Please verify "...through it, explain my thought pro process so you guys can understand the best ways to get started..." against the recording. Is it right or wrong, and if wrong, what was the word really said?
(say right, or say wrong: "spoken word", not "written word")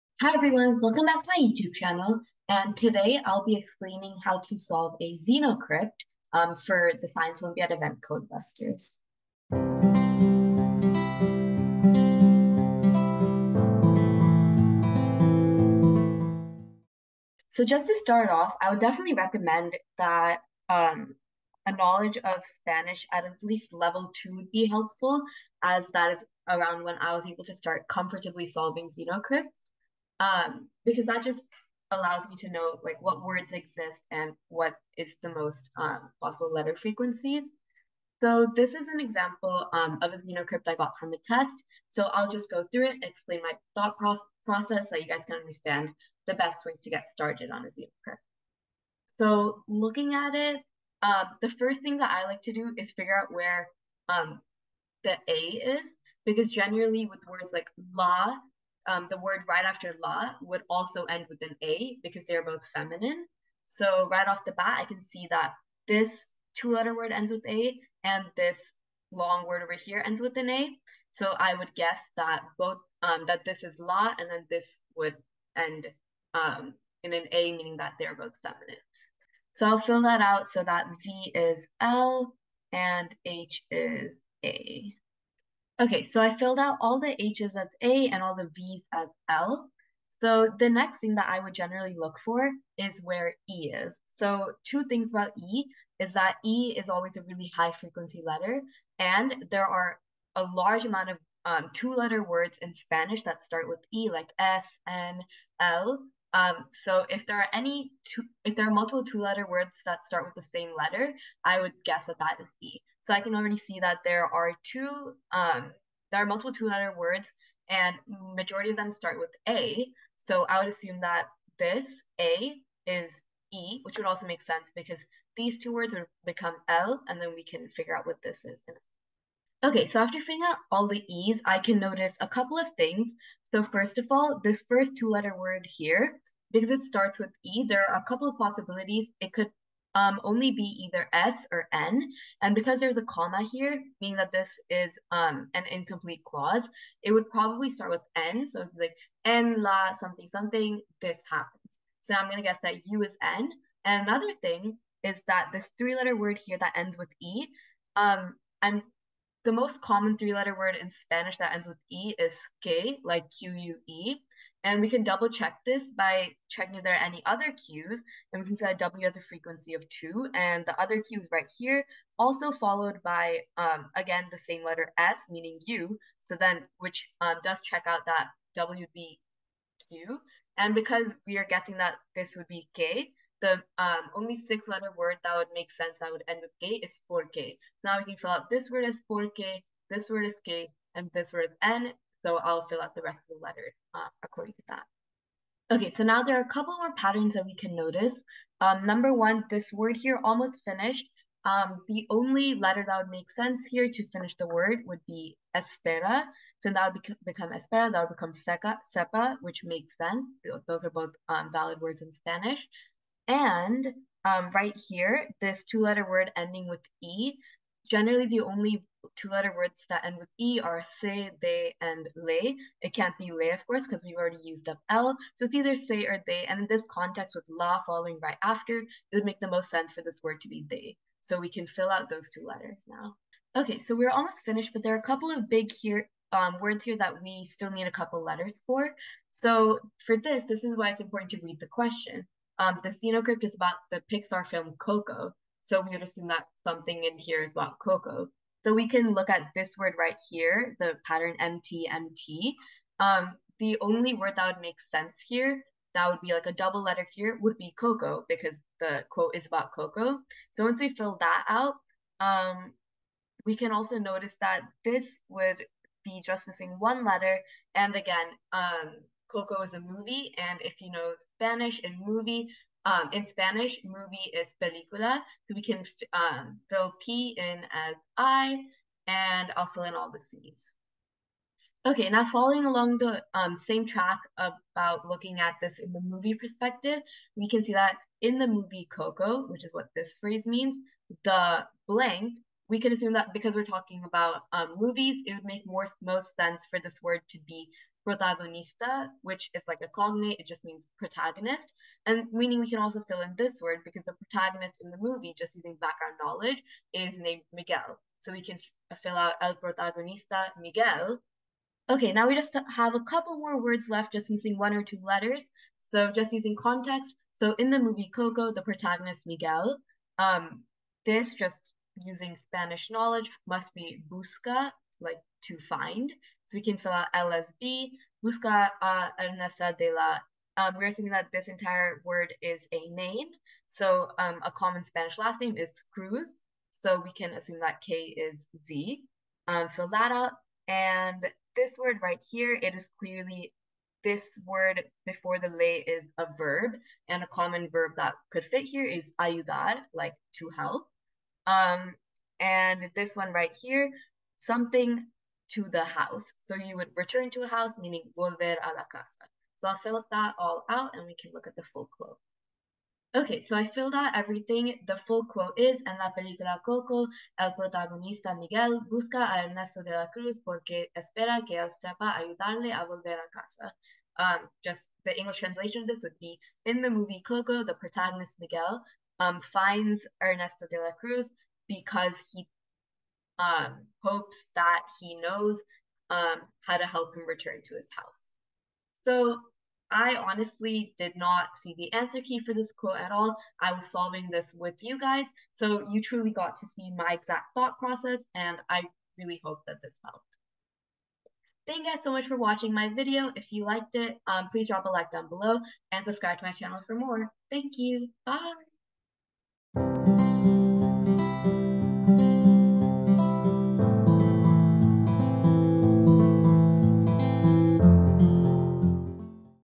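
right.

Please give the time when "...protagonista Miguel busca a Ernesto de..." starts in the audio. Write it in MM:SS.
06:07.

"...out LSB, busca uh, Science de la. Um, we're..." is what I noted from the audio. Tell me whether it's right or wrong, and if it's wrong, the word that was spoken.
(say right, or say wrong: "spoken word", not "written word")
wrong: "Ernesto", not "Science".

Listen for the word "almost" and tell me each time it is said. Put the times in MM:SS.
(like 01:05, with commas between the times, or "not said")
03:20, 03:54.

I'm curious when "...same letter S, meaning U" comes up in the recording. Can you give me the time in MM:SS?
02:54.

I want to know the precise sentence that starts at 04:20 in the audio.
So once we fill that out, um, we can also notice that this would be just missing one letter.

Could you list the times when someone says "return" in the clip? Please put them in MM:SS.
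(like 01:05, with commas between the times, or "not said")
05:56, 06:27.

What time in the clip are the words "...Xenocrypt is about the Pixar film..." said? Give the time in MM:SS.
04:02.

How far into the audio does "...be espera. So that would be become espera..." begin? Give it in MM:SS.
03:25.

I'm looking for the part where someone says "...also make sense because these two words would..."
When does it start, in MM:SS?
02:04.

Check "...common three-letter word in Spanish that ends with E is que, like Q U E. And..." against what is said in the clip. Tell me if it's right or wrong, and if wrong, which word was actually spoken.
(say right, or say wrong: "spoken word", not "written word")
right.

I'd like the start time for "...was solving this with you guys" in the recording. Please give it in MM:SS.
06:33.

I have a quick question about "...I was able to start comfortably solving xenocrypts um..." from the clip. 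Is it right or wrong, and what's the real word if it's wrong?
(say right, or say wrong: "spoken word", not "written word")
right.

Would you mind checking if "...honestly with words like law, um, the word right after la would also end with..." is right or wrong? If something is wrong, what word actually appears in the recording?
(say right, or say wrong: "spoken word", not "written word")
wrong: "generally", not "honestly".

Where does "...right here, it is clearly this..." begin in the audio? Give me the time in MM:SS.
05:42.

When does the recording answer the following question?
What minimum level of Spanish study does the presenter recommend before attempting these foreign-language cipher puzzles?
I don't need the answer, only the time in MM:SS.
00:23.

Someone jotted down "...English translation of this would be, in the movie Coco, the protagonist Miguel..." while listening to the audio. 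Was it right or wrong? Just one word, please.
right.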